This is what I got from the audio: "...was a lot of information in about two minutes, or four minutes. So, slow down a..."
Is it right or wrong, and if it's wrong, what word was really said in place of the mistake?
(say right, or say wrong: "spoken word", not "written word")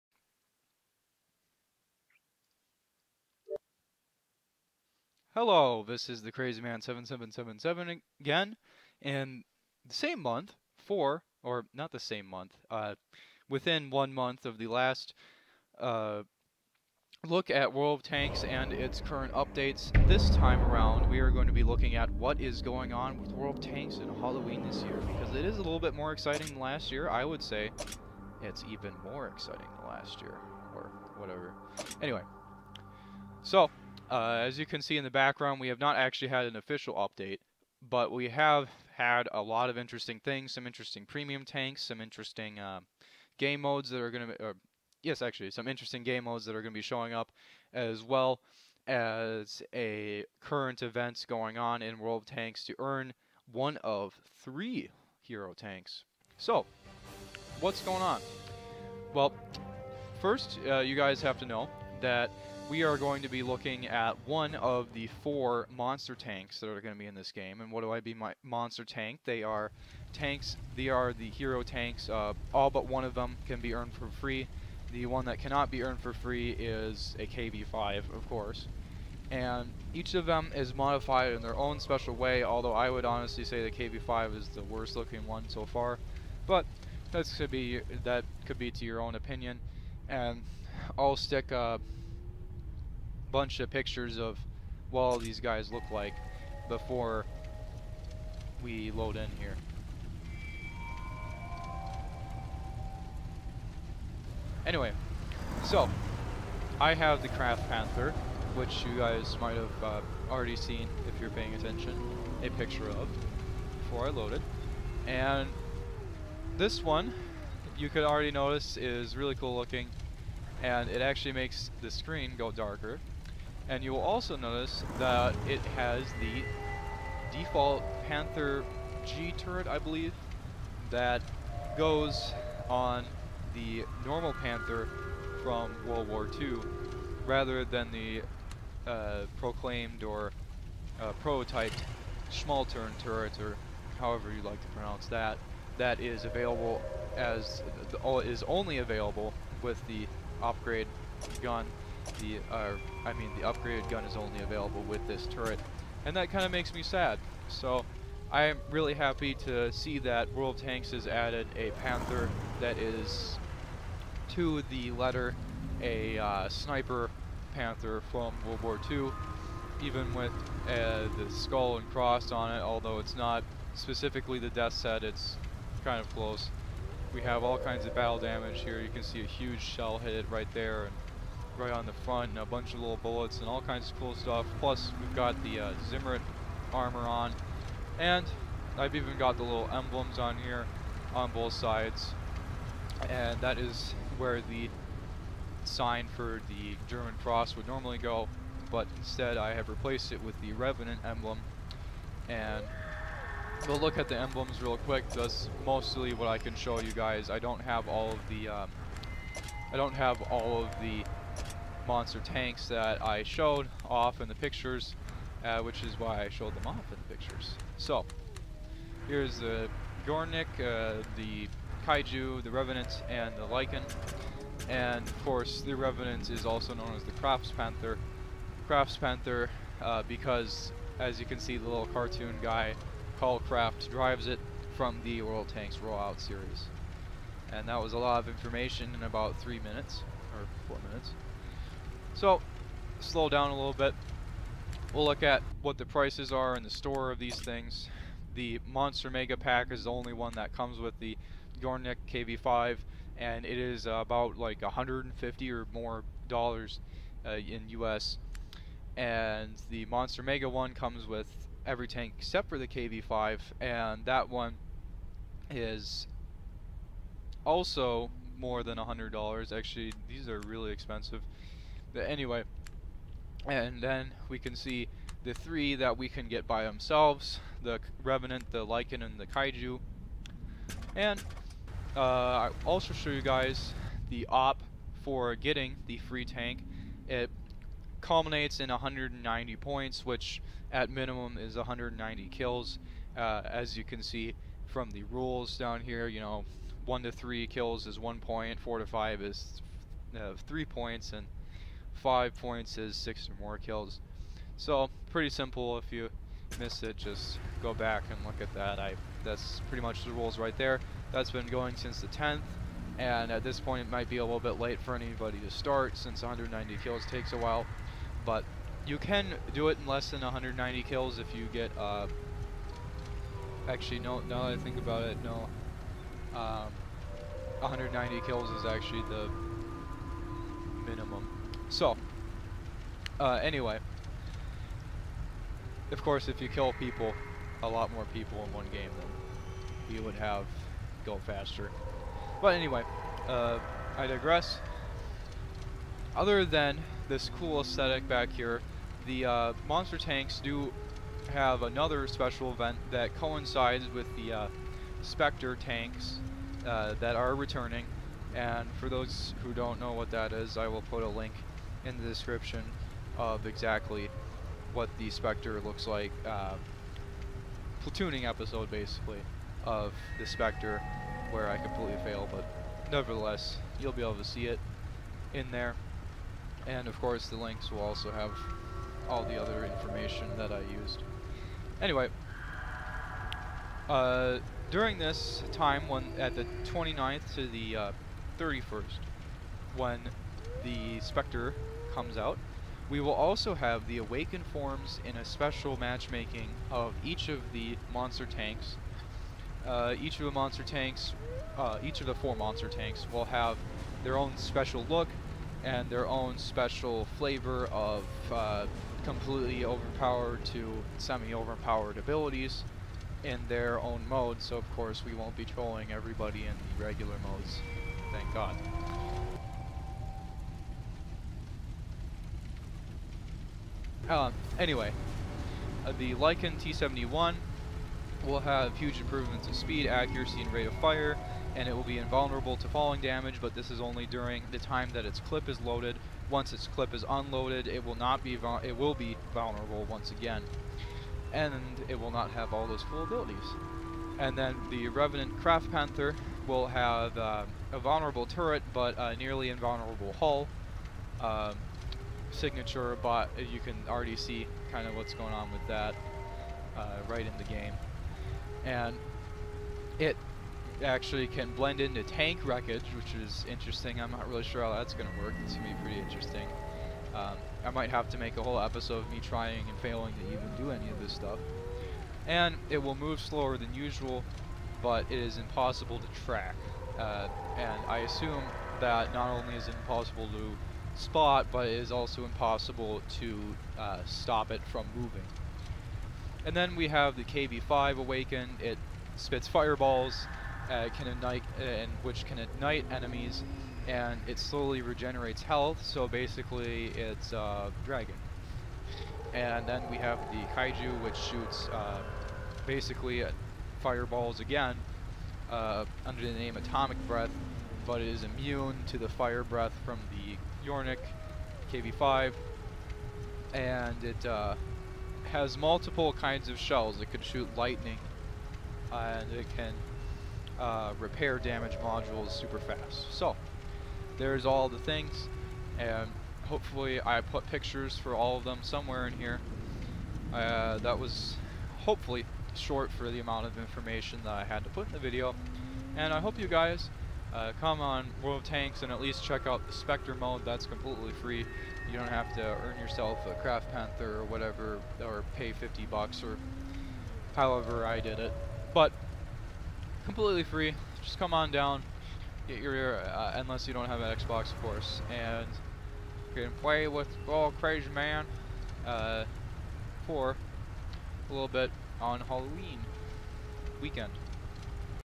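wrong: "three", not "two".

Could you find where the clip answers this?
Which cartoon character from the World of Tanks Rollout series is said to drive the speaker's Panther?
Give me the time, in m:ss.
3:53.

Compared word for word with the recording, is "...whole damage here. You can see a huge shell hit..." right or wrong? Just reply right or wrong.
wrong.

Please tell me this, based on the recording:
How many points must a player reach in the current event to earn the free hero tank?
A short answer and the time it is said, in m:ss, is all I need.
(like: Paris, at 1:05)
190, at 4:47.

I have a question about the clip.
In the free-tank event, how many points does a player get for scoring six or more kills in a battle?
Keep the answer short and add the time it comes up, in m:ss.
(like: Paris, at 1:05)
5, at 5:02.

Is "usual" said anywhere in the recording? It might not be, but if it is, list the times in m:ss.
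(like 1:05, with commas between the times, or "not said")
7:53.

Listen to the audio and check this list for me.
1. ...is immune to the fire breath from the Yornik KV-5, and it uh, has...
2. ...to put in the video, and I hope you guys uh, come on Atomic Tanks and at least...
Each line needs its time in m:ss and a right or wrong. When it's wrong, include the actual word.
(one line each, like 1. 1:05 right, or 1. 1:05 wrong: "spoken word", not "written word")
1. 8:28 right
2. 8:54 wrong: "World", not "Atomic".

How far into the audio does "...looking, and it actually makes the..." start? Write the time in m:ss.
1:59.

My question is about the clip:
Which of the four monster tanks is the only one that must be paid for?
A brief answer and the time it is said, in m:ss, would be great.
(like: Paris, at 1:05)
KV-5, at 1:14.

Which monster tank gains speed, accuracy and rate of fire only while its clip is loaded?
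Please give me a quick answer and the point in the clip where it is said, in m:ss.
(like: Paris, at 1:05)
Lycan T-71, at 7:05.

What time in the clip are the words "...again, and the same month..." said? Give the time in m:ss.
0:08.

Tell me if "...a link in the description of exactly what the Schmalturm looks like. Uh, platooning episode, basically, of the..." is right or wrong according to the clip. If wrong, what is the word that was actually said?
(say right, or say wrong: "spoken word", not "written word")
wrong: "Spectre", not "Schmalturm".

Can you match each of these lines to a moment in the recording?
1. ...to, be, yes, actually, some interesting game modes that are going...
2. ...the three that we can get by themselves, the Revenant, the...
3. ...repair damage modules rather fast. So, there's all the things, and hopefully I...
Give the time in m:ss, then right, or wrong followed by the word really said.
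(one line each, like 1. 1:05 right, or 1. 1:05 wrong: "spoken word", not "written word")
1. 0:44 right
2. 4:35 right
3. 8:40 wrong: "super", not "rather".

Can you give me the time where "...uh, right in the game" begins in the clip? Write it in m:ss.
7:36.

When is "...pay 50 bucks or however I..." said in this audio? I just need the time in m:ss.
9:05.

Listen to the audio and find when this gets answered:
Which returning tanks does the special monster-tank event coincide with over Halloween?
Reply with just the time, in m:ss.
5:55.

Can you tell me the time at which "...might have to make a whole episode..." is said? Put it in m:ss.
7:47.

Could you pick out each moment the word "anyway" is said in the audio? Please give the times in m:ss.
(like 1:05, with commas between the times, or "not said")
0:32, 1:44, 4:32, 5:33, 5:42, 6:21, 7:04.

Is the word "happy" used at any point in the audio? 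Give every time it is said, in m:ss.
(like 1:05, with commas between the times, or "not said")
2:38.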